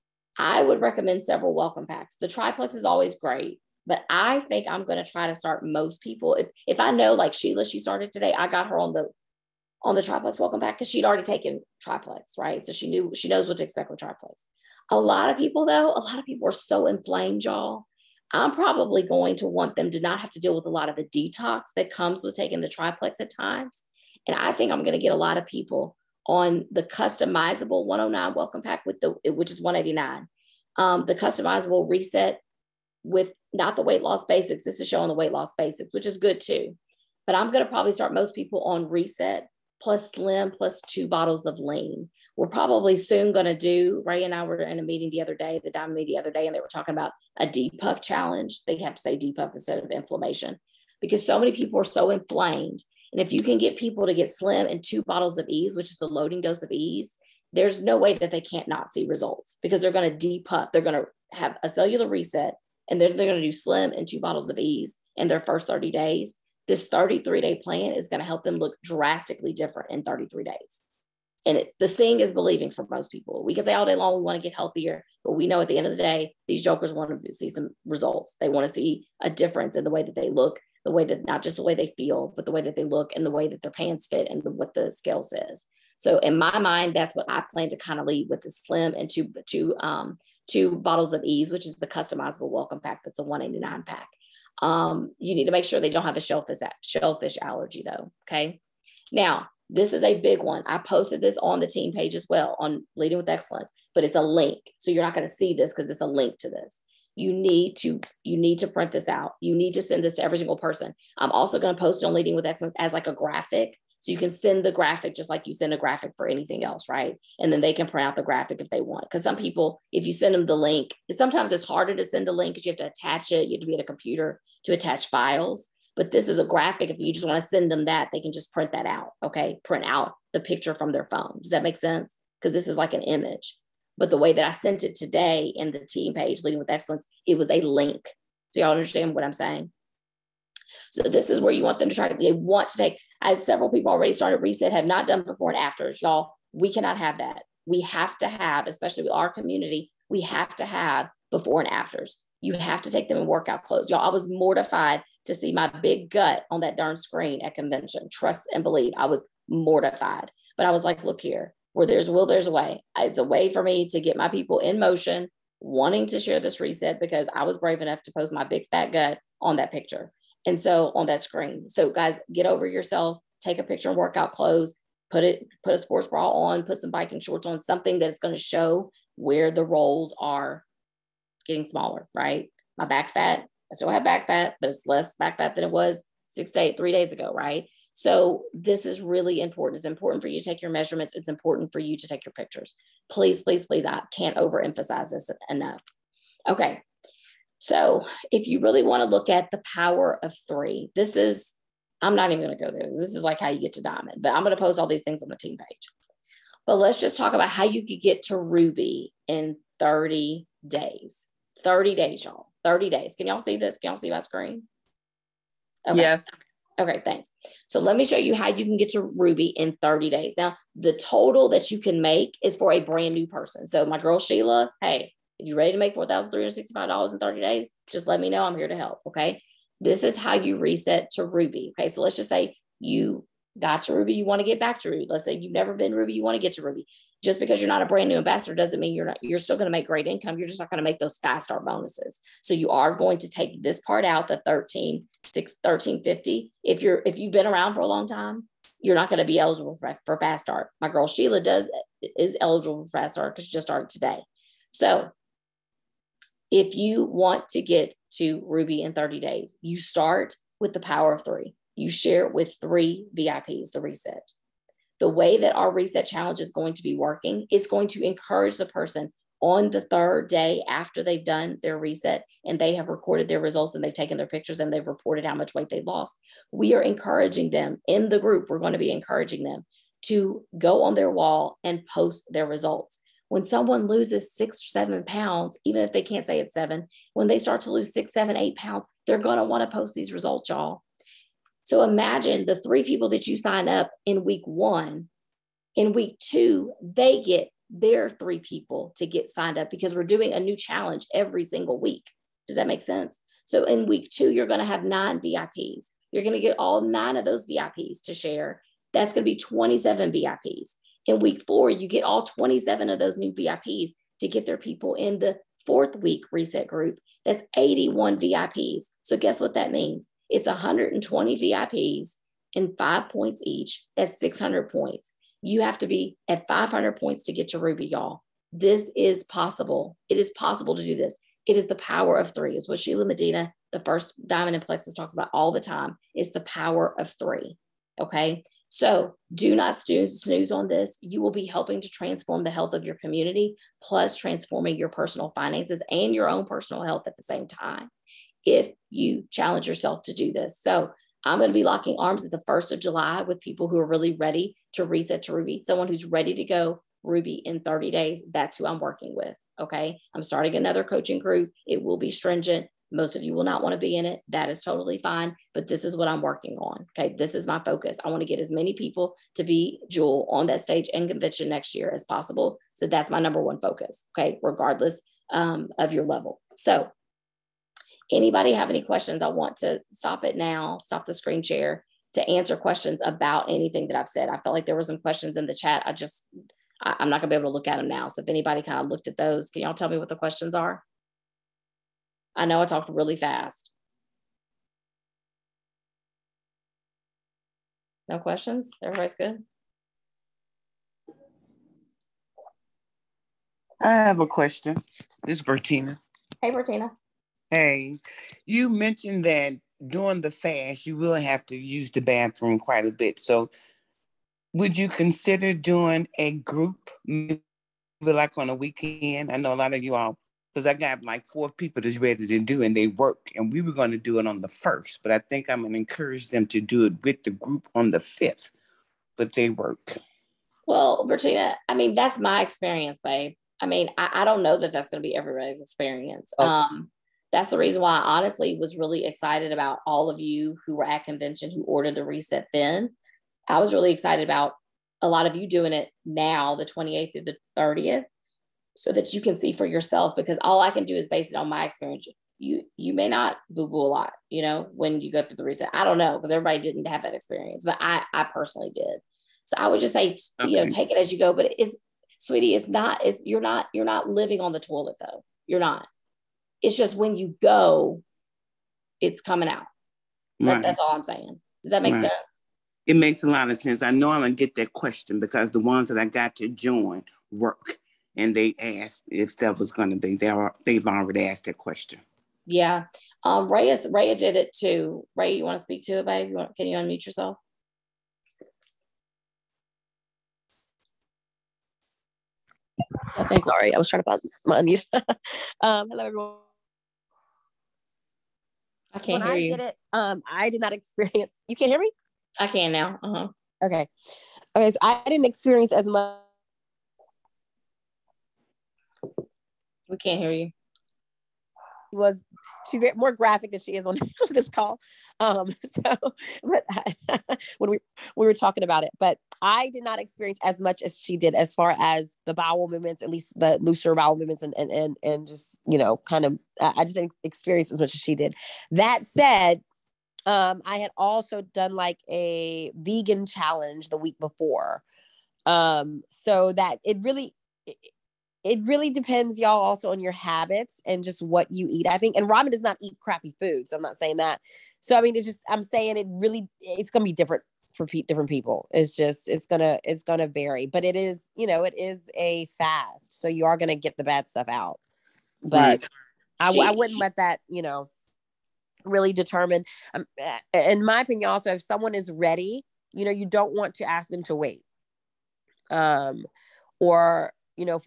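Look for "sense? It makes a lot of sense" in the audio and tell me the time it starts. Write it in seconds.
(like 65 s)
472 s.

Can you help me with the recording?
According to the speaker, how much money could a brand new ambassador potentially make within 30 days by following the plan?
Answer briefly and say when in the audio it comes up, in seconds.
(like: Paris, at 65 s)
$4,365, at 225 s.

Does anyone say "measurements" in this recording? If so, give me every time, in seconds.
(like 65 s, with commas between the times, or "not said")
190 s.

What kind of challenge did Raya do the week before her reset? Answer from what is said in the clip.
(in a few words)
Vegan challenge.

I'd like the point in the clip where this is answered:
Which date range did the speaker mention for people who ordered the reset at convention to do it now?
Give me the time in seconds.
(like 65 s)
446 s.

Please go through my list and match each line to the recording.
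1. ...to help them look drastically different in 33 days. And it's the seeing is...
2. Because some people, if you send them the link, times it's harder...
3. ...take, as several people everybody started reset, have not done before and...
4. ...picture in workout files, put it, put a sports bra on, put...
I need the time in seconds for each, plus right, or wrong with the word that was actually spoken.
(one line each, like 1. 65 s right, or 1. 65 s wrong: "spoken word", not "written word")
1. 68 s right
2. 119 s wrong: "sometimes", not "times"
3. 142 s wrong: "already", not "everybody"
4. 173 s wrong: "clothes", not "files".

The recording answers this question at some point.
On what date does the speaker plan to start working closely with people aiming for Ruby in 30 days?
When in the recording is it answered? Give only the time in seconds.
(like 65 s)
352 s.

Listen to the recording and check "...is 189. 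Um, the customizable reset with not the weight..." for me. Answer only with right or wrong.
right.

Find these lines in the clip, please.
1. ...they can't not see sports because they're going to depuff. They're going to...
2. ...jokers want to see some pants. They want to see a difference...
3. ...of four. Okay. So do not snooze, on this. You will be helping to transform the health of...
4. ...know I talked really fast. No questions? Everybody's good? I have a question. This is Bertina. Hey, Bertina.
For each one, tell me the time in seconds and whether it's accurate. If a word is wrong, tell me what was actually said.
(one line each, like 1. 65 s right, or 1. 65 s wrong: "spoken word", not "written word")
1. 58 s wrong: "results", not "sports"
2. 76 s wrong: "results", not "pants"
3. 336 s wrong: "three", not "four"
4. 392 s right.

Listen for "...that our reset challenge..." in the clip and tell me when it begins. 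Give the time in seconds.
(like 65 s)
265 s.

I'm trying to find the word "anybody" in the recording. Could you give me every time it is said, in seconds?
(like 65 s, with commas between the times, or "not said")
378 s, 388 s.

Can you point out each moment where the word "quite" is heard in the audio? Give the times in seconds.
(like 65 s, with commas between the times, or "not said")
412 s.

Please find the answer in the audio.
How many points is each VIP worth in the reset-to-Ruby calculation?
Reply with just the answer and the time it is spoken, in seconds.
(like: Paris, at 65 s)
5, at 322 s.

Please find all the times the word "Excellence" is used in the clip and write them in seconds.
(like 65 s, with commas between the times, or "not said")
103 s, 112 s, 136 s.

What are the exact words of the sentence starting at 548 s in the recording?
It's just it's gonna it's gonna vary.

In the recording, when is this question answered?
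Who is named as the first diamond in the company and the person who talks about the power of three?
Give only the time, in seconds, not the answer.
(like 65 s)
332 s.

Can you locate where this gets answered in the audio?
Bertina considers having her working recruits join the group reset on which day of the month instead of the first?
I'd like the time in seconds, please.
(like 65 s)
427 s.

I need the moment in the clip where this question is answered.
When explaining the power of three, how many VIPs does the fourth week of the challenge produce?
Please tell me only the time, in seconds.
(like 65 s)
317 s.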